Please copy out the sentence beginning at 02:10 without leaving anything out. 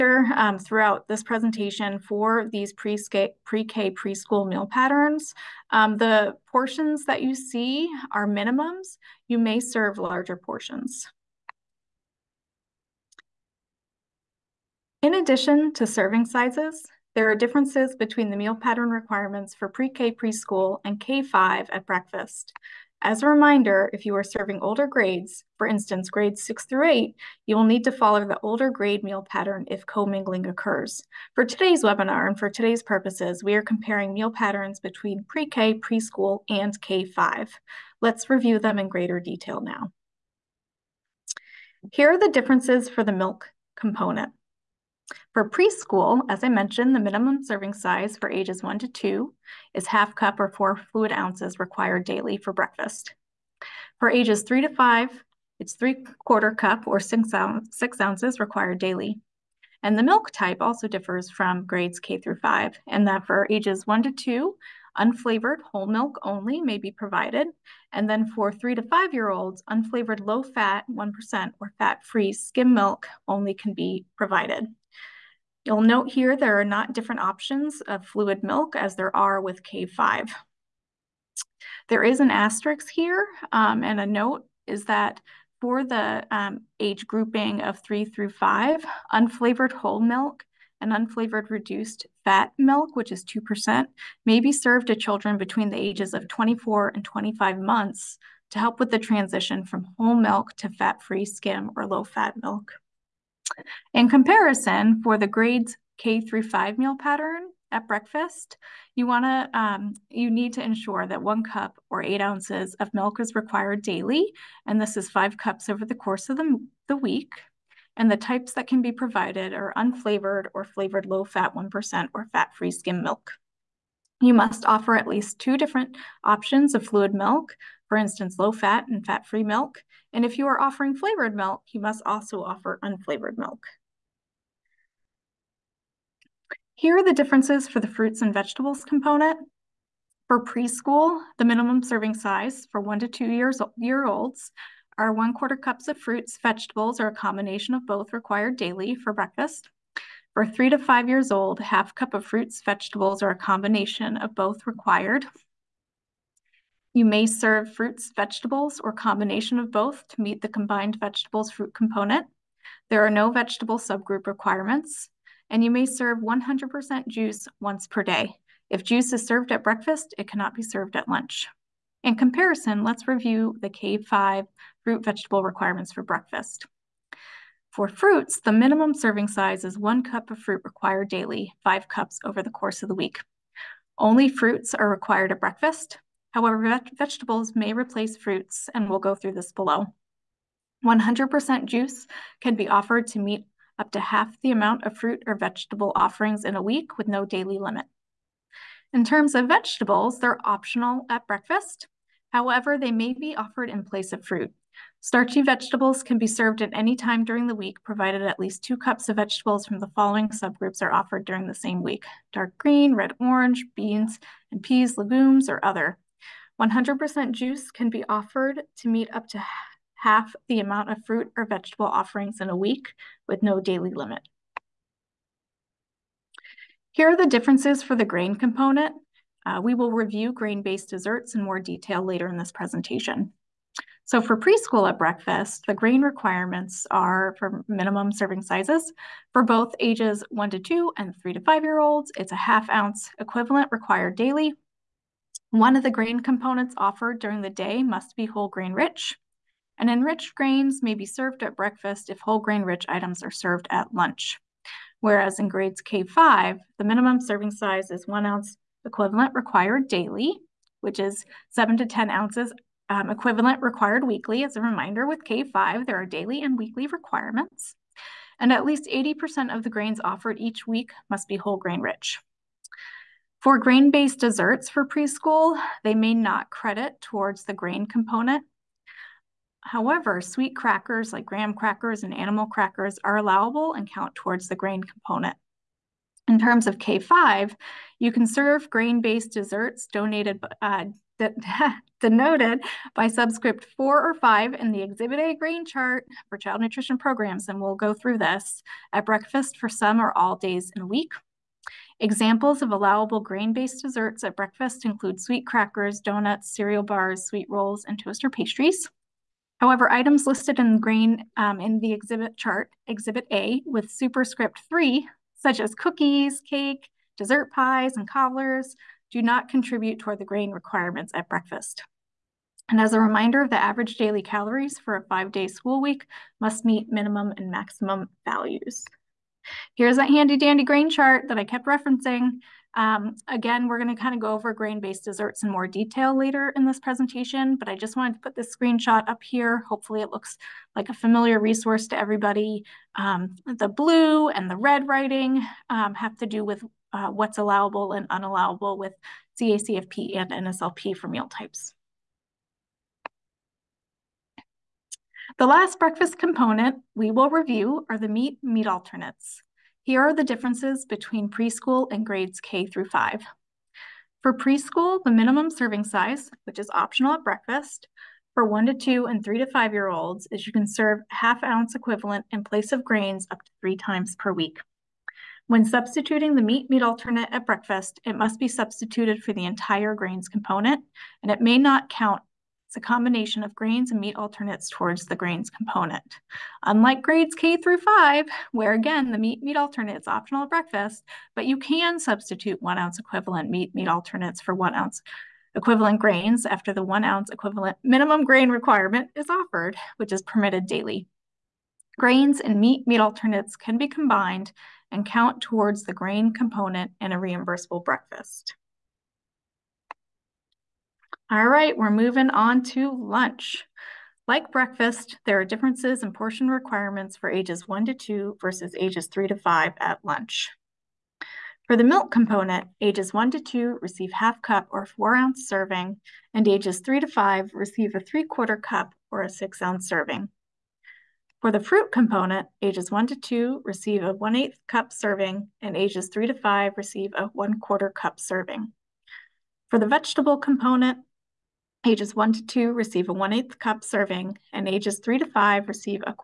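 And if you are offering flavored milk, you must also offer unflavored milk.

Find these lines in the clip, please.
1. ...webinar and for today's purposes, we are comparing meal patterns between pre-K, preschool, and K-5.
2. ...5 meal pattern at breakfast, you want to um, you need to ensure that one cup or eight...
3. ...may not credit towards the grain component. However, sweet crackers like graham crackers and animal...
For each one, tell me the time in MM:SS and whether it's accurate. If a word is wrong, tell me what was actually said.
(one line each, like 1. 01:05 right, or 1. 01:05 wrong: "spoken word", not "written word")
1. 00:31 right
2. 01:46 right
3. 04:35 right.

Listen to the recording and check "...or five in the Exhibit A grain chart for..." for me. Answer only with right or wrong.
right.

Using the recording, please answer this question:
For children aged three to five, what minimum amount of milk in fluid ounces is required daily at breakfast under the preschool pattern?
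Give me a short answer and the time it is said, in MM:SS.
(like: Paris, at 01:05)
6 ounces, at 00:57.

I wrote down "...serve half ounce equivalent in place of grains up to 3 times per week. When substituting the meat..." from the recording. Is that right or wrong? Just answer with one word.
right.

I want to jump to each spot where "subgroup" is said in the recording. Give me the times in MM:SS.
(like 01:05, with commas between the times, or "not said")
02:43, 03:30.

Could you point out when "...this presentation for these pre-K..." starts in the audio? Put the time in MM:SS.
00:01.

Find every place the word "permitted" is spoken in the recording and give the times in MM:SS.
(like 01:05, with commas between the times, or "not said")
06:40.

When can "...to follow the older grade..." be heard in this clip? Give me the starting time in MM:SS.
00:27.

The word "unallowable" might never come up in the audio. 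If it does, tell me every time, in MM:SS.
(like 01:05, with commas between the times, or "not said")
05:48.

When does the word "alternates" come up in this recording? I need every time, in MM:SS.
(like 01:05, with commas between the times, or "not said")
05:58, 06:16, 06:24, 06:29, 06:33, 06:42.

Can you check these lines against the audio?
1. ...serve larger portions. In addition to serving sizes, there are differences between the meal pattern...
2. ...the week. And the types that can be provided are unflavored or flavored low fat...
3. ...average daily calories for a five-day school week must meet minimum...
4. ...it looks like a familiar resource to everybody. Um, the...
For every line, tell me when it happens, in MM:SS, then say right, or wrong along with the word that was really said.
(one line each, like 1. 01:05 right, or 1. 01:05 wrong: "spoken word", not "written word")
1. 00:09 right
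2. 01:56 right
3. 05:23 right
4. 05:40 right.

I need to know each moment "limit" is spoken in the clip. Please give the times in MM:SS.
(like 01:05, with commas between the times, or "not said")
03:17, 03:43.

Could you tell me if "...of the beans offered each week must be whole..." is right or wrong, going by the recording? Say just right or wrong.
wrong.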